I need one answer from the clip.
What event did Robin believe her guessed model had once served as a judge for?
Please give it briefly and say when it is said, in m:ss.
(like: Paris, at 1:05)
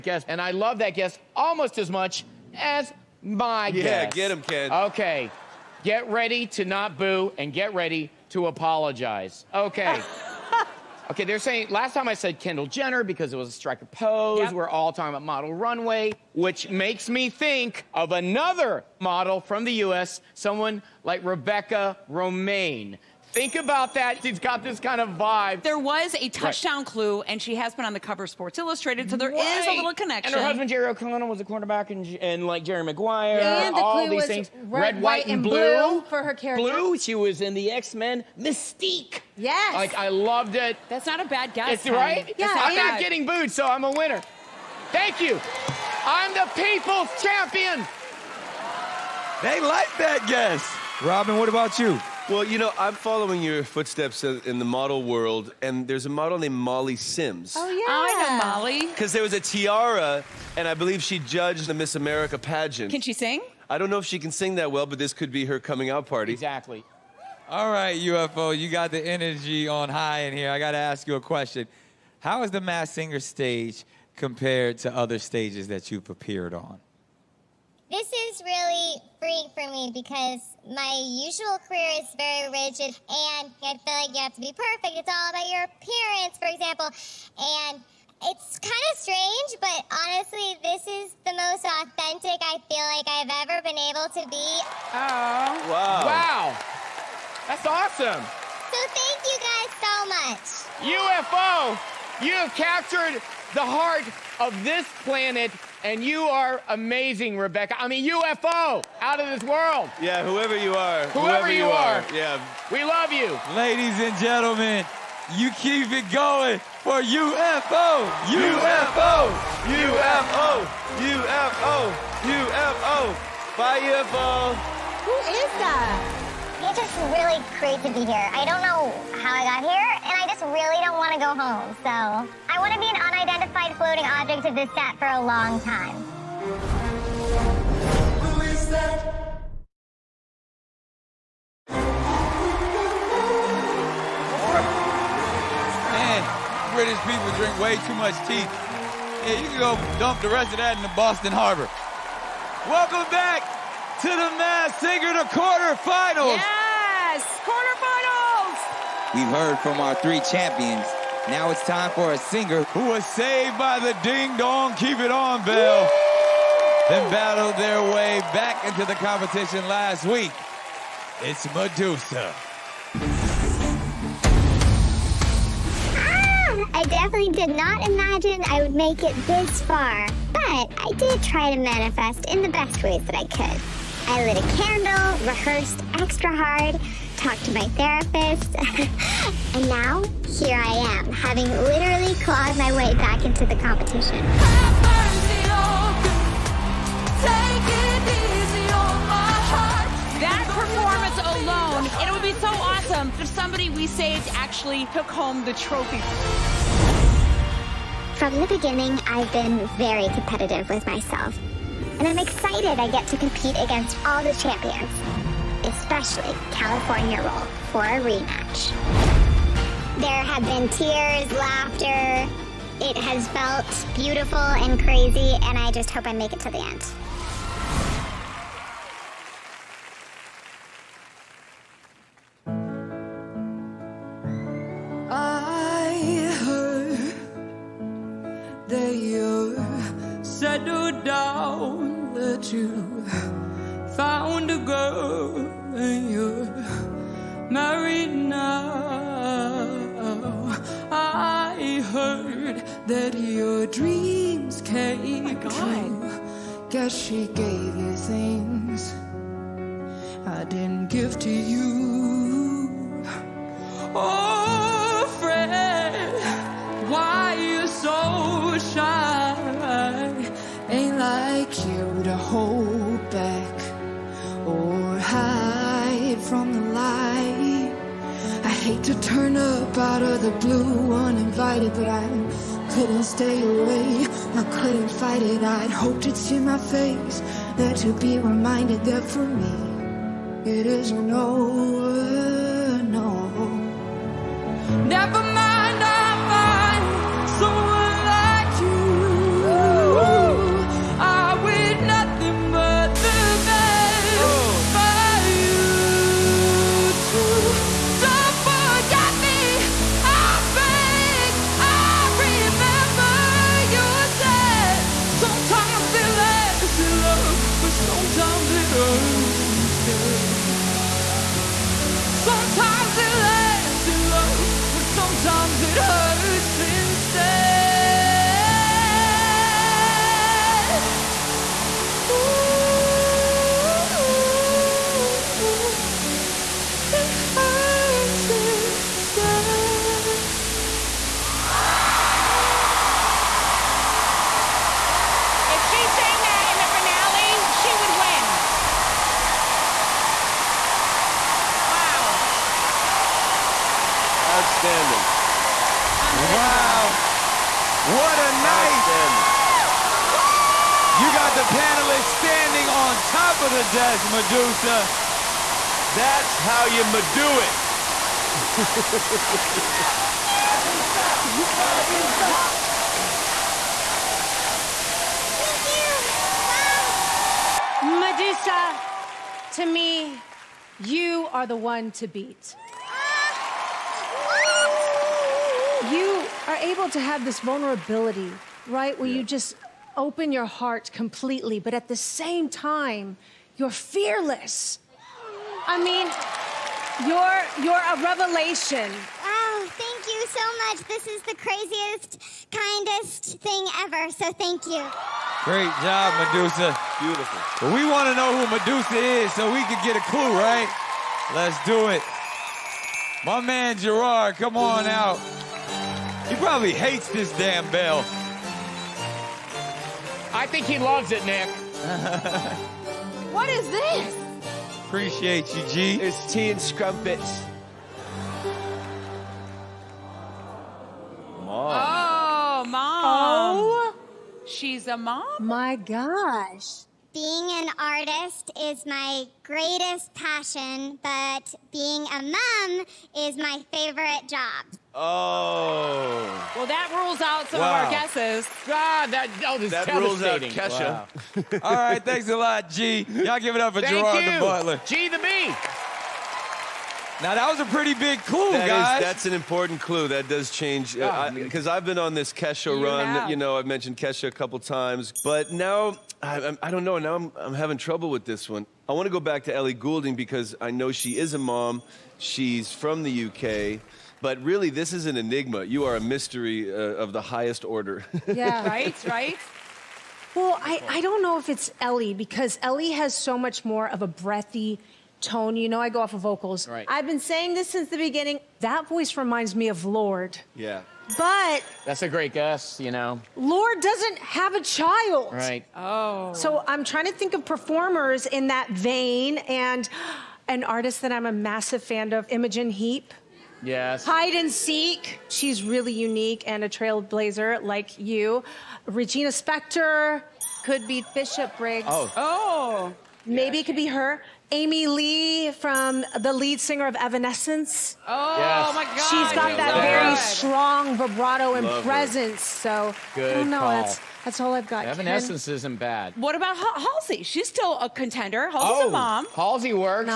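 Miss America pageant, at 1:01.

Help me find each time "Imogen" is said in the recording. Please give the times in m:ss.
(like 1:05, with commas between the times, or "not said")
8:22.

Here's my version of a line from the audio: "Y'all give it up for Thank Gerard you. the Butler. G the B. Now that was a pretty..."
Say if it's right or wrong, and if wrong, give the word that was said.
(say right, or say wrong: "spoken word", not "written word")
right.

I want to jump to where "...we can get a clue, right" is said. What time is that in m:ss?
6:49.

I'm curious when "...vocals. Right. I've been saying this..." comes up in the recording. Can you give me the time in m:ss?
8:06.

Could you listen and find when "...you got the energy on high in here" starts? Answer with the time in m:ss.
1:08.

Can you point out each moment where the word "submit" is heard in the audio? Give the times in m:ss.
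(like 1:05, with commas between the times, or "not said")
not said.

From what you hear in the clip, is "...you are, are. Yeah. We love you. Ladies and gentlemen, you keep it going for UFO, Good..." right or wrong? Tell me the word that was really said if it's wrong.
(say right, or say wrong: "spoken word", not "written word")
wrong: "UFO", not "Good".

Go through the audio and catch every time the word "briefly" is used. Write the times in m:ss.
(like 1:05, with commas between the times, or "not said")
not said.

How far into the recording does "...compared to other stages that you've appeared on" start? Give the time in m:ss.
1:14.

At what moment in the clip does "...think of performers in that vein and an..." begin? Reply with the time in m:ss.
8:17.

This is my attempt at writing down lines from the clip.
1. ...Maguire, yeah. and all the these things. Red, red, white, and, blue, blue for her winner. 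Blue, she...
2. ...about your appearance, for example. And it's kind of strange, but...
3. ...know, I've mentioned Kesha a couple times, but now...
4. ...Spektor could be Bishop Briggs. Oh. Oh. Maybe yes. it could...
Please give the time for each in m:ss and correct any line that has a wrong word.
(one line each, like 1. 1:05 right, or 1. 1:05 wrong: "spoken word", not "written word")
1. 0:32 wrong: "character", not "winner"
2. 1:25 right
3. 7:43 right
4. 8:29 right.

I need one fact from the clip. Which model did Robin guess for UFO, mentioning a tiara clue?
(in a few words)
Molly Sims.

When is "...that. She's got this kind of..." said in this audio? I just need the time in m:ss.
0:23.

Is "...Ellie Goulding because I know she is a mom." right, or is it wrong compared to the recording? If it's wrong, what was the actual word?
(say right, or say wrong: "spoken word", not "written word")
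right.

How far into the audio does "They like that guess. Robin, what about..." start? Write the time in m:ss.
0:49.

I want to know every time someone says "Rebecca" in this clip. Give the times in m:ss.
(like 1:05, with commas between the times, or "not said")
0:21, 1:47.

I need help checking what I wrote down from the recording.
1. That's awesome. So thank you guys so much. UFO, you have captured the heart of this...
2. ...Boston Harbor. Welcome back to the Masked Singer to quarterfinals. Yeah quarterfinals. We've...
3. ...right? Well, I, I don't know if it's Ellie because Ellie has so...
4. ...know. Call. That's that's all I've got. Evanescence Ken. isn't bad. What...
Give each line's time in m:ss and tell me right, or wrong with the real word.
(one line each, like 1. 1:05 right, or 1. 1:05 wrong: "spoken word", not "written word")
1. 1:37 right
2. 2:30 right
3. 7:59 right
4. 8:43 right.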